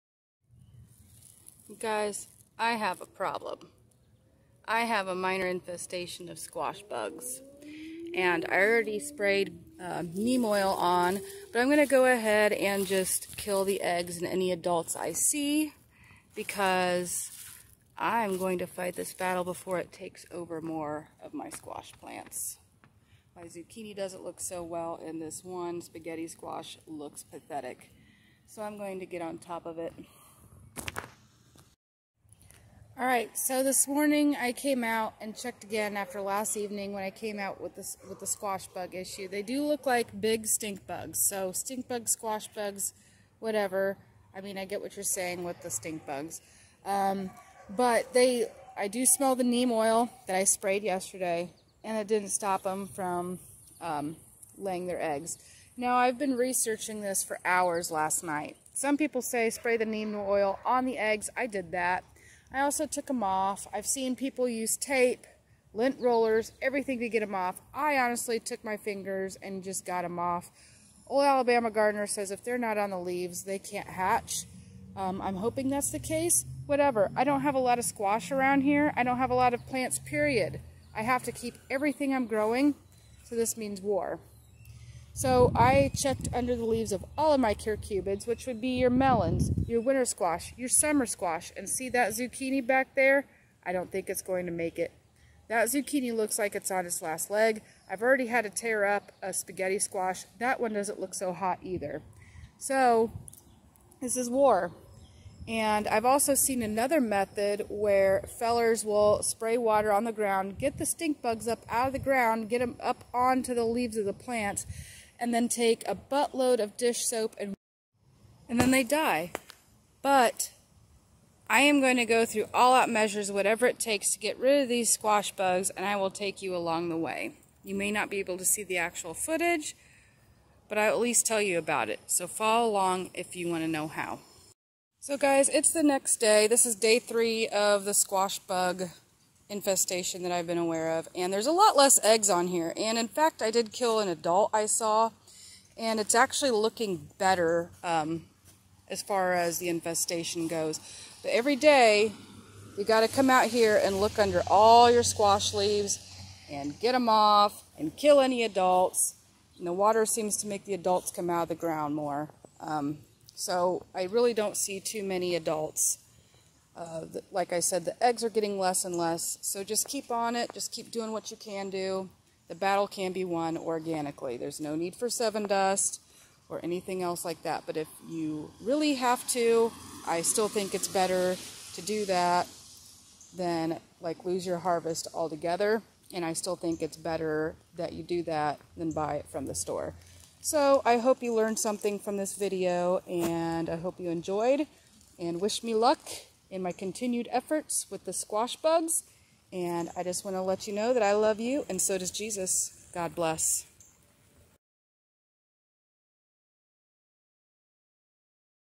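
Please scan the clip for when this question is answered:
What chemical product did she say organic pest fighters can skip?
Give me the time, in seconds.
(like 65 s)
175 s.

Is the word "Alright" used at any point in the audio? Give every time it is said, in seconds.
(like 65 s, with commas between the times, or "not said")
33 s.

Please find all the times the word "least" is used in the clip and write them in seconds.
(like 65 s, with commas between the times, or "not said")
130 s.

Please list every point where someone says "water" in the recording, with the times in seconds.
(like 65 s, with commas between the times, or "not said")
109 s, 159 s.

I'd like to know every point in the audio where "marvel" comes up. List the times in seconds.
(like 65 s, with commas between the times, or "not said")
not said.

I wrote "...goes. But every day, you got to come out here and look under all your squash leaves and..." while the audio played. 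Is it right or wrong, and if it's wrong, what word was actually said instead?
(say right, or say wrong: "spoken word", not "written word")
right.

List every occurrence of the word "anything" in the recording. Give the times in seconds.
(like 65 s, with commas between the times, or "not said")
176 s.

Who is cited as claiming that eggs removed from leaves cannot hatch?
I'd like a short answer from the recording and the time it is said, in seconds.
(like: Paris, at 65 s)
Old Alabama gardener, at 71 s.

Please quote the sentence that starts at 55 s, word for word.
Now, I've been researching this for hours last night.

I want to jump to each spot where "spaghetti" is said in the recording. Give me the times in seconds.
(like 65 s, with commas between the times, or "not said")
25 s, 99 s.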